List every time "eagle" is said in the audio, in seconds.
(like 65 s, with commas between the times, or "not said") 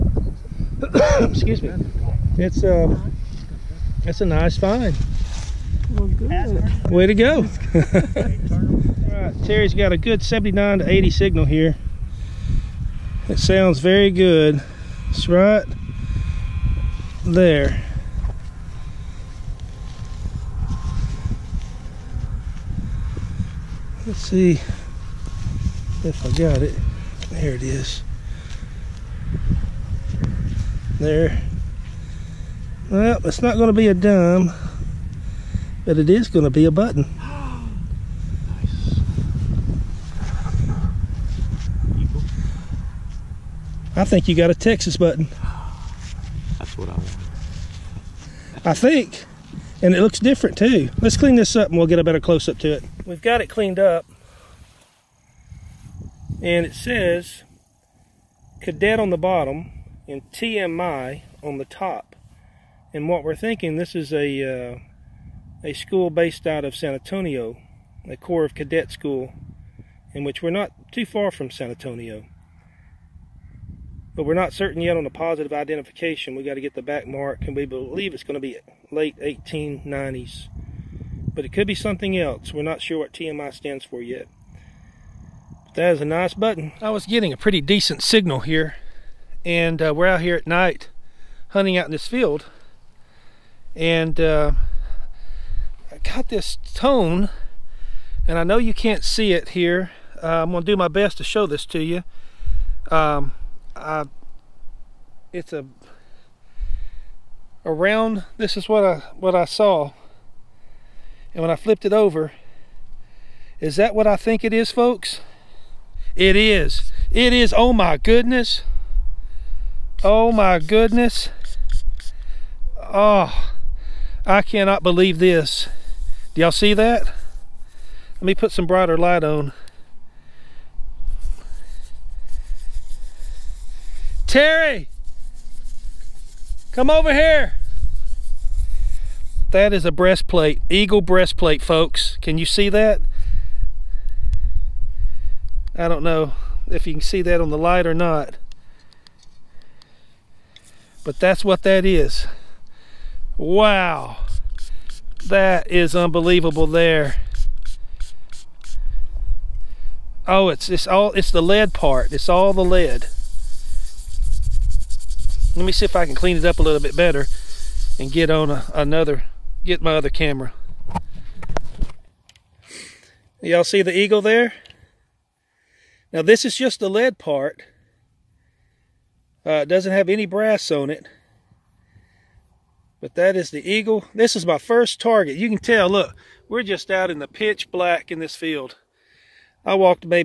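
140 s, 173 s, 183 s.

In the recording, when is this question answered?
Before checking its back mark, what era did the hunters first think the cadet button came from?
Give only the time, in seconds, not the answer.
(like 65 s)
78 s.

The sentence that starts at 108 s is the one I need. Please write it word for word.
This is what I what I saw, and when I flipped it over, is that what I think it is, folks?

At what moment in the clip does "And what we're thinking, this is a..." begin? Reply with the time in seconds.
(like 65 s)
62 s.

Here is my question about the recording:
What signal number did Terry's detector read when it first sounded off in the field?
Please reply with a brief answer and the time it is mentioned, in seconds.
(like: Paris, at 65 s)
79 to 80, at 10 s.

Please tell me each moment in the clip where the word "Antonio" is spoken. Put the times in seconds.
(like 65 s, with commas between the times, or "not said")
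66 s, 71 s.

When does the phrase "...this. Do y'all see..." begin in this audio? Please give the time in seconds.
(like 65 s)
125 s.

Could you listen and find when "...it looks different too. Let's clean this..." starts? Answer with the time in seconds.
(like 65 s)
49 s.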